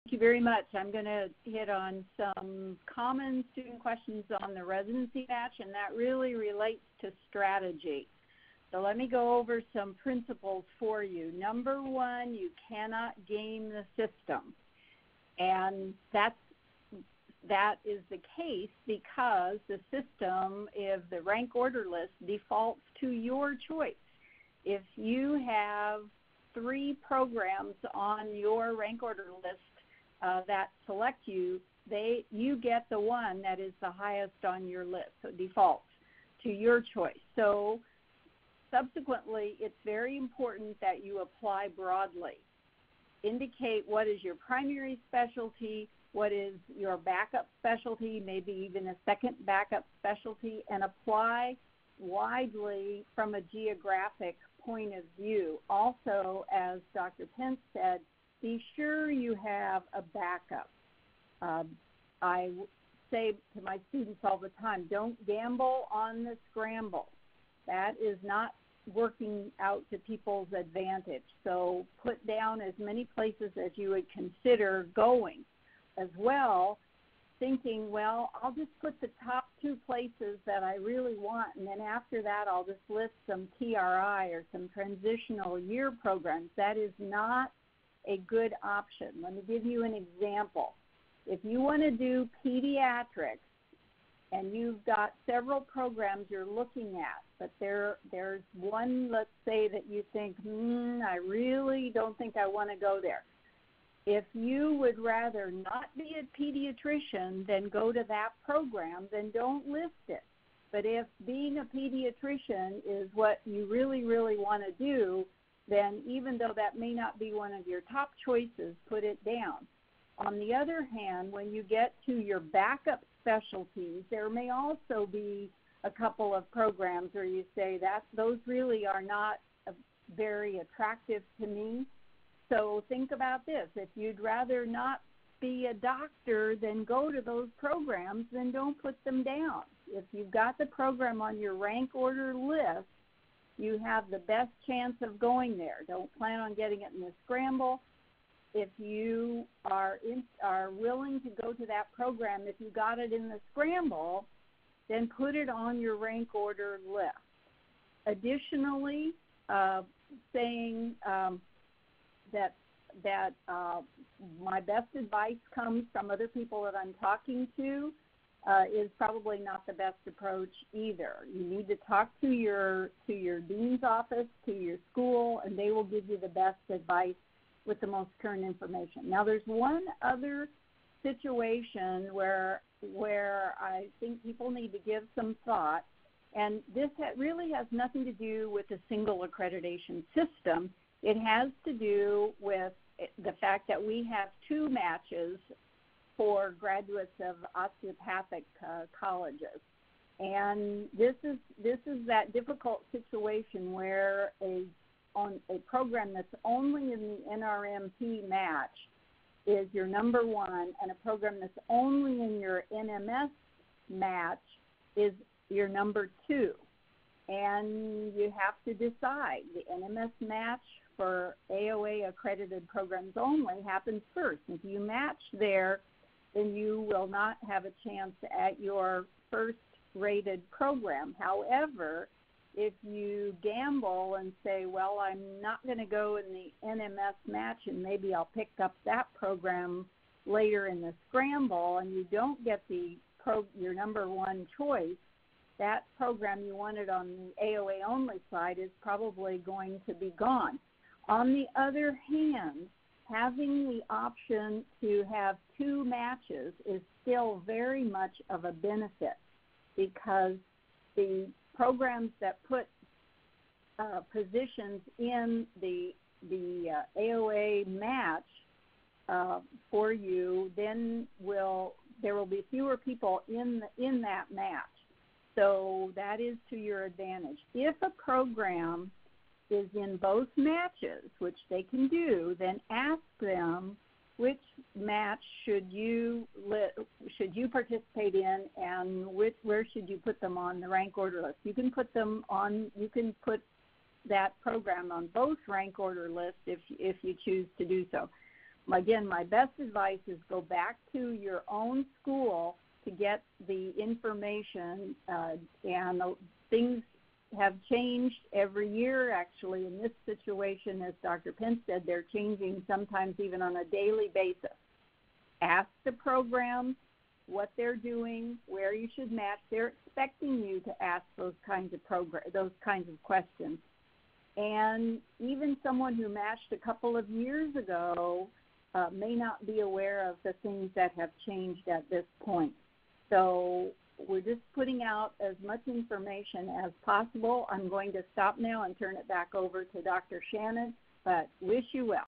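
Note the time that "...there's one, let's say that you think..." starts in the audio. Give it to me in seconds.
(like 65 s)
98 s.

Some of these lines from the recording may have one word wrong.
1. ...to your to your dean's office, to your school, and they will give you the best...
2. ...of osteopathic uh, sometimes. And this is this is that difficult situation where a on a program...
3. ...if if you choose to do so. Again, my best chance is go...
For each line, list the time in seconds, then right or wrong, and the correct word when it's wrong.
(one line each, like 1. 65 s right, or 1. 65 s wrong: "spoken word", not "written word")
1. 172 s right
2. 197 s wrong: "colleges", not "sometimes"
3. 296 s wrong: "advice", not "chance".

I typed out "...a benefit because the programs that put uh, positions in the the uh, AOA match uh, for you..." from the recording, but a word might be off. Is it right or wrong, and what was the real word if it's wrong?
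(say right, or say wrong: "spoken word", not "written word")
right.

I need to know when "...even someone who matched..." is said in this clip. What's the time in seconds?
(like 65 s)
325 s.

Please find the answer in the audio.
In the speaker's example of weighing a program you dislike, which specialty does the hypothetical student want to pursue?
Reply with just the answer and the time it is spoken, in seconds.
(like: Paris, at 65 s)
Pediatrics, at 92 s.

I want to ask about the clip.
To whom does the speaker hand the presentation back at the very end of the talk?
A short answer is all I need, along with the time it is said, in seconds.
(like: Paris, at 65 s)
Dr. Shannon, at 339 s.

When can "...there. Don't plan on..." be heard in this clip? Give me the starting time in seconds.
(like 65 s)
145 s.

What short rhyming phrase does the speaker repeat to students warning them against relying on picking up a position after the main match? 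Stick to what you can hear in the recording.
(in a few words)
Don't gamble on the scramble.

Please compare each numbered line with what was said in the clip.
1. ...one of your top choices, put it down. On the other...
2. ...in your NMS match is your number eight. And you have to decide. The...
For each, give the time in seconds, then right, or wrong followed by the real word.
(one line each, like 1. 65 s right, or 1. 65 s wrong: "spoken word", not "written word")
1. 117 s right
2. 212 s wrong: "two", not "eight".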